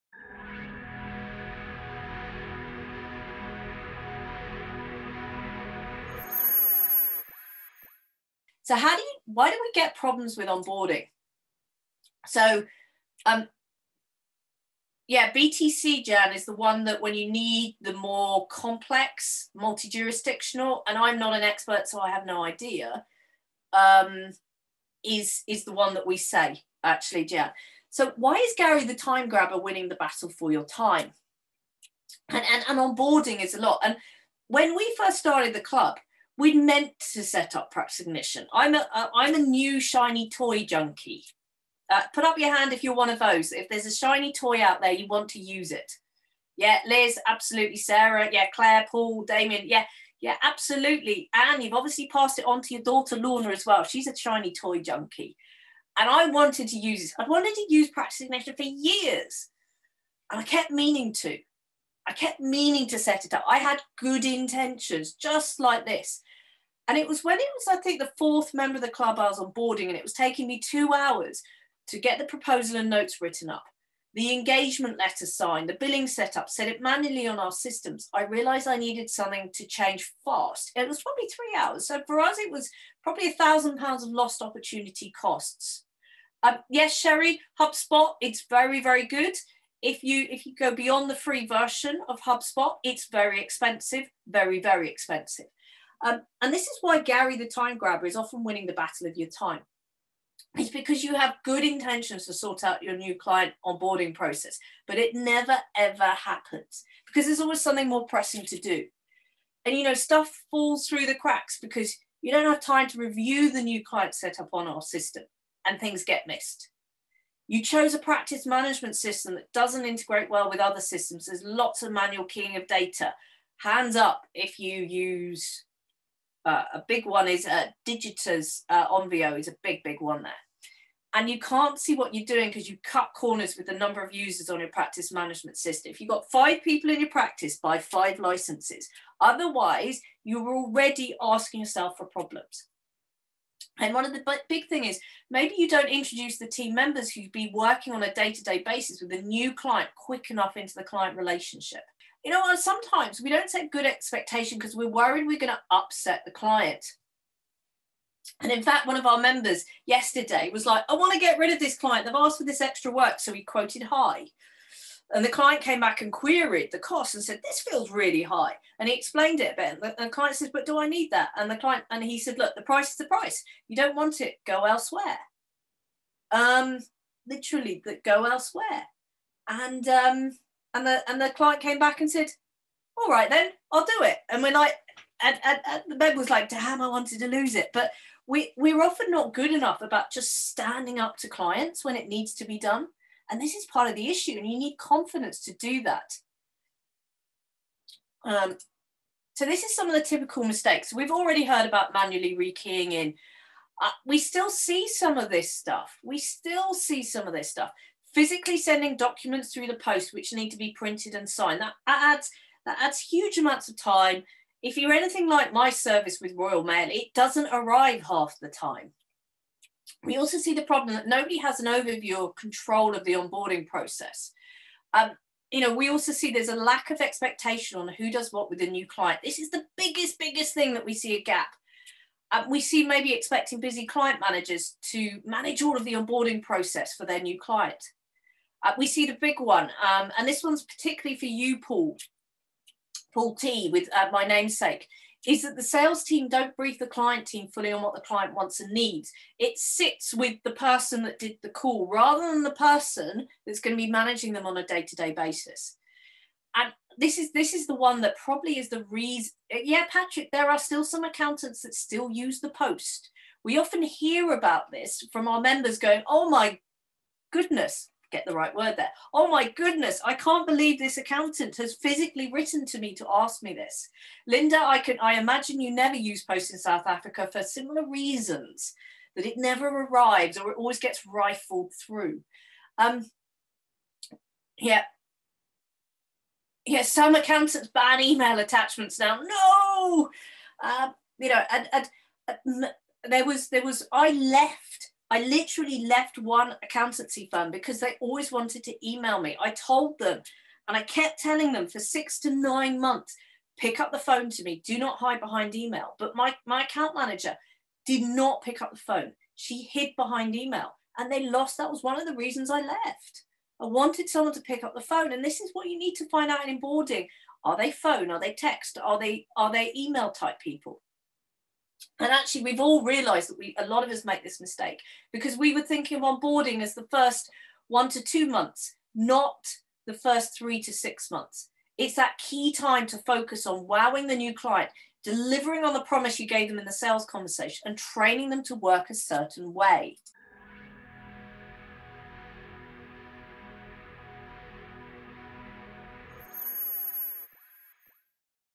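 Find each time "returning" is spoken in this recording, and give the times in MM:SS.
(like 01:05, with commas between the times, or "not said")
not said.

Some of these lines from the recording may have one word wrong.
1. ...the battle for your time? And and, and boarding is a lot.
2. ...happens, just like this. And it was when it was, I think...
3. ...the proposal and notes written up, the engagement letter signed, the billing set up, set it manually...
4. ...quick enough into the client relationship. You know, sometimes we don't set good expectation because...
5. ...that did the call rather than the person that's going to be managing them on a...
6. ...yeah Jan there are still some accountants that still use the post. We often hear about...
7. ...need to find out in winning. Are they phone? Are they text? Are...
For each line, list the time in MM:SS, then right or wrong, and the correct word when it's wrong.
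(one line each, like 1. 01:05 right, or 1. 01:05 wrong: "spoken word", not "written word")
1. 00:29 wrong: "onboarding", not "boarding"
2. 01:04 wrong: "intentions", not "happens"
3. 01:12 right
4. 02:29 right
5. 04:11 right
6. 04:19 wrong: "Patrick", not "Jan"
7. 05:15 wrong: "boarding", not "winning".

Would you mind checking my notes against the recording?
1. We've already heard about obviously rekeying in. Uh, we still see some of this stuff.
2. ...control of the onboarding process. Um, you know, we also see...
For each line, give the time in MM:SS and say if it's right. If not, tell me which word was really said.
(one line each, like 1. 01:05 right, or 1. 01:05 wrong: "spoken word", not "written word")
1. 03:20 wrong: "manually", not "obviously"
2. 03:42 right.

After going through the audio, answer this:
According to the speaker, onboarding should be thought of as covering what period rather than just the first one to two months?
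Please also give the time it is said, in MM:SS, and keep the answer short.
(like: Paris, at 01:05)
first 3 to 6 months, at 05:29.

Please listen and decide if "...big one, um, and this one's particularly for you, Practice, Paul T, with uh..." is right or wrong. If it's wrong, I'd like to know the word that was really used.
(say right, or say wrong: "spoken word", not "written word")
wrong: "Paul", not "Practice".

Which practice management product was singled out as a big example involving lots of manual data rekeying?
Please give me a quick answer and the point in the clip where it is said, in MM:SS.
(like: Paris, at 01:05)
Onvio, at 02:08.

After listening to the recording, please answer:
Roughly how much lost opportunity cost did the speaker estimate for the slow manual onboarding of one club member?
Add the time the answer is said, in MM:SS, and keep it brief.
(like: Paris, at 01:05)
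1000 pounds, at 01:23.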